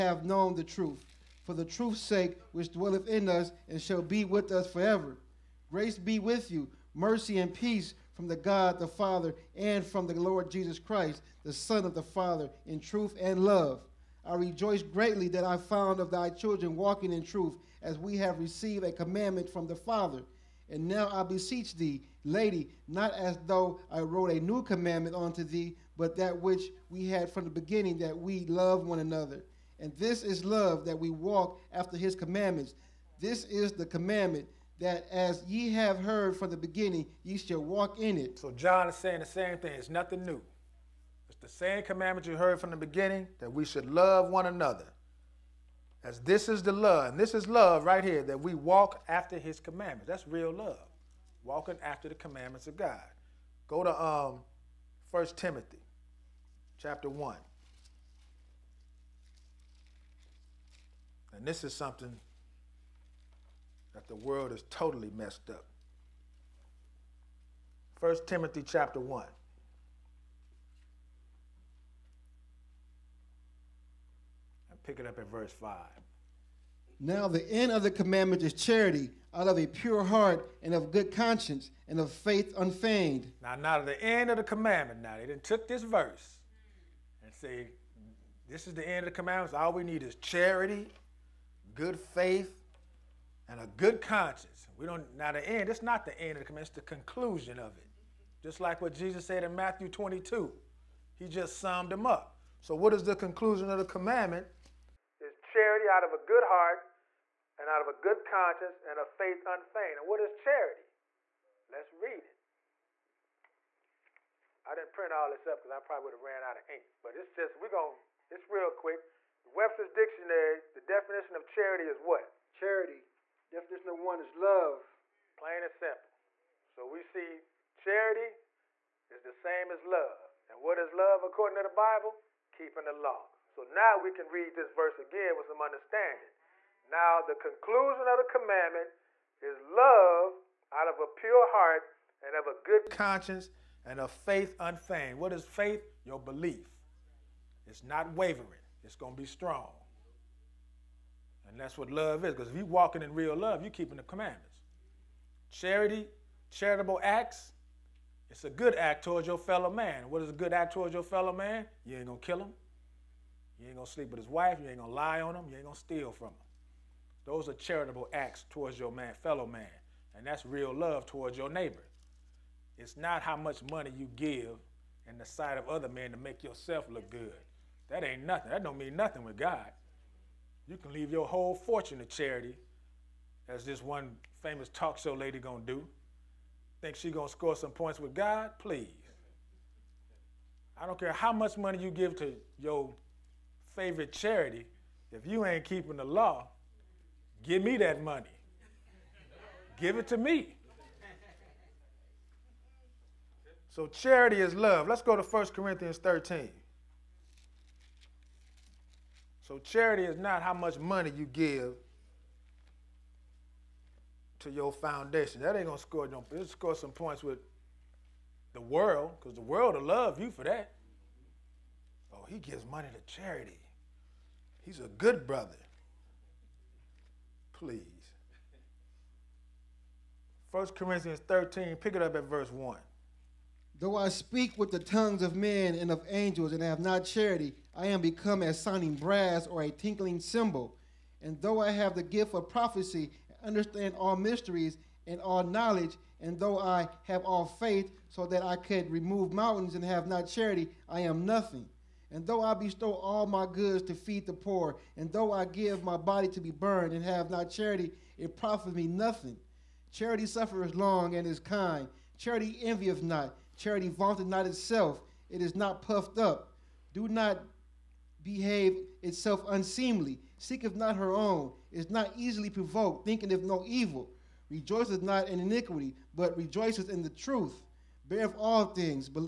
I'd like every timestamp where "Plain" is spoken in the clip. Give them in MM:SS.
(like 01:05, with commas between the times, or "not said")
02:05.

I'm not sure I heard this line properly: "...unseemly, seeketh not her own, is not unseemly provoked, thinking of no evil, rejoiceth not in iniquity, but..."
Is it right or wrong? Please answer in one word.
wrong.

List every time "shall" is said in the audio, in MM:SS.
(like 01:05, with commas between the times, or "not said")
00:03, 00:37.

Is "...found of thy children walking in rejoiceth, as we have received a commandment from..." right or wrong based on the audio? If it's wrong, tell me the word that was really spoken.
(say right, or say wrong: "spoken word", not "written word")
wrong: "truth", not "rejoiceth".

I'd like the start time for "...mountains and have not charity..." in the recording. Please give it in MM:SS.
04:09.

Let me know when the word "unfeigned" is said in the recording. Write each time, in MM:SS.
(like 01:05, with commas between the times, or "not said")
01:22, 01:49, 02:24.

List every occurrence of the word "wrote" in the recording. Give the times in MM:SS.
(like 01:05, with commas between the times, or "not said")
00:23.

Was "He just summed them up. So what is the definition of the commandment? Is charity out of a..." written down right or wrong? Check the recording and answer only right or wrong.
wrong.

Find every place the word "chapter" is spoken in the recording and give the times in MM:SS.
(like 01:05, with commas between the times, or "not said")
00:56, 01:08.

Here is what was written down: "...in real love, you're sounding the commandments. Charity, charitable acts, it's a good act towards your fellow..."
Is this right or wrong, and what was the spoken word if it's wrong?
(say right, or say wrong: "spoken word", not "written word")
wrong: "keeping", not "sounding".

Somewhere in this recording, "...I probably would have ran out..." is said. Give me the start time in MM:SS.
01:55.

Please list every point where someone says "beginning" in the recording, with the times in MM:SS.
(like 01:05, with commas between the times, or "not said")
00:27, 00:36, 00:42.